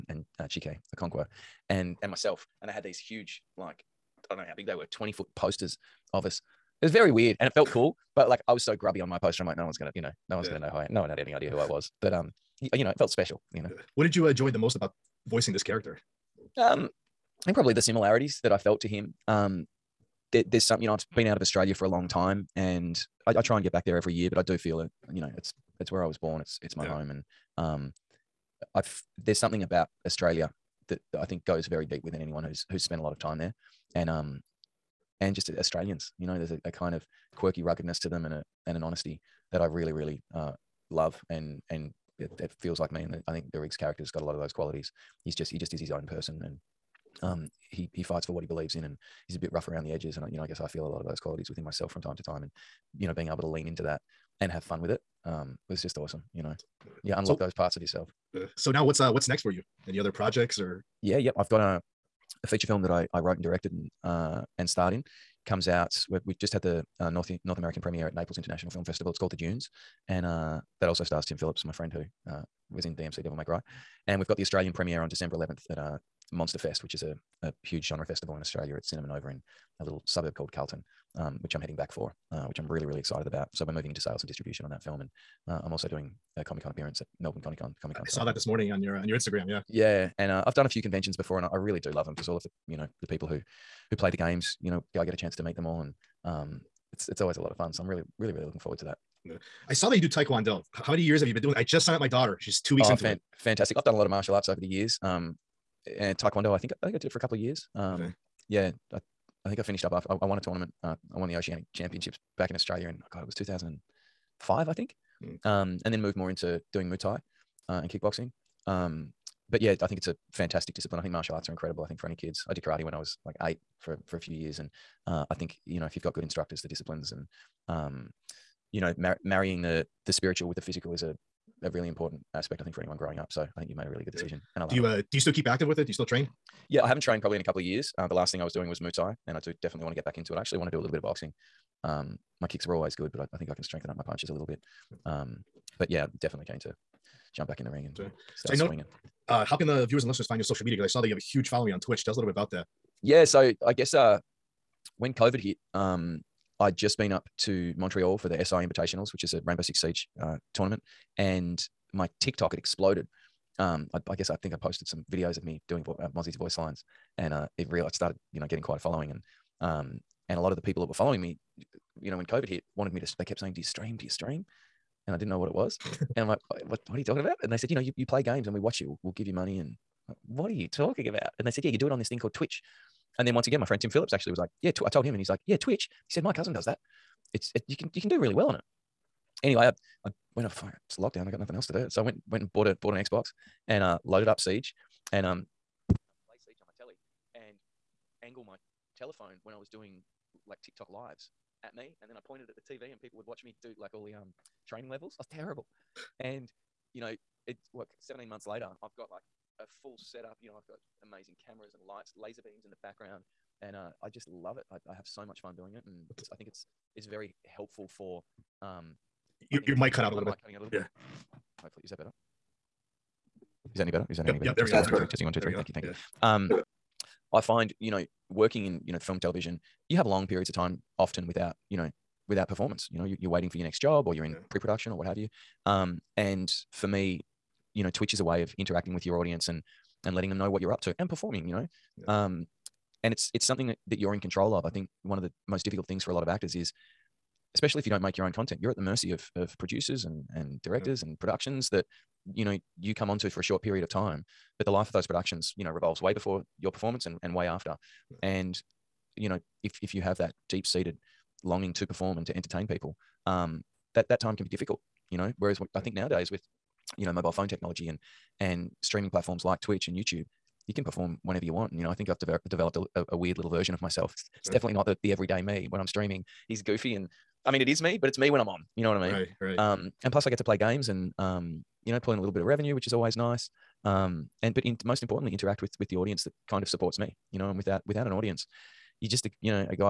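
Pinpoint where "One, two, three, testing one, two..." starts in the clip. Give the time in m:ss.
3:44.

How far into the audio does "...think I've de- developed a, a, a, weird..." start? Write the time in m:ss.
4:31.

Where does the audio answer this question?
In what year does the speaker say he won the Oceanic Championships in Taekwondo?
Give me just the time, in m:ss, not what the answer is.
1:53.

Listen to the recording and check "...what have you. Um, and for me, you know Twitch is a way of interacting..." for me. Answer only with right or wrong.
right.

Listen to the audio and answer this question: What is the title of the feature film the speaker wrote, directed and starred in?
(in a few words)
The Dunes.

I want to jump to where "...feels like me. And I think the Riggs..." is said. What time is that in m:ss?
0:42.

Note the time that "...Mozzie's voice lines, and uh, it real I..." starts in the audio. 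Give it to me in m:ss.
2:46.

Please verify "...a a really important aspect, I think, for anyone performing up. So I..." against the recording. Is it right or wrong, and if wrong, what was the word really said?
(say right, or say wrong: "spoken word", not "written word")
wrong: "growing", not "performing".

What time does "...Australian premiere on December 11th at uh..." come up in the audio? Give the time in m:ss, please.
1:14.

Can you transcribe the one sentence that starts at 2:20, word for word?
I actually want to do a little bit of boxing.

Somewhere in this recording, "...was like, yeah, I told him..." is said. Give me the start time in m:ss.
3:04.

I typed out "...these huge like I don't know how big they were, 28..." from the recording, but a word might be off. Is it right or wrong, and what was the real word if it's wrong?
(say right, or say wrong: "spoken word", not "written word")
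wrong: "20", not "28".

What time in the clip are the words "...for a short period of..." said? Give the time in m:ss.
4:13.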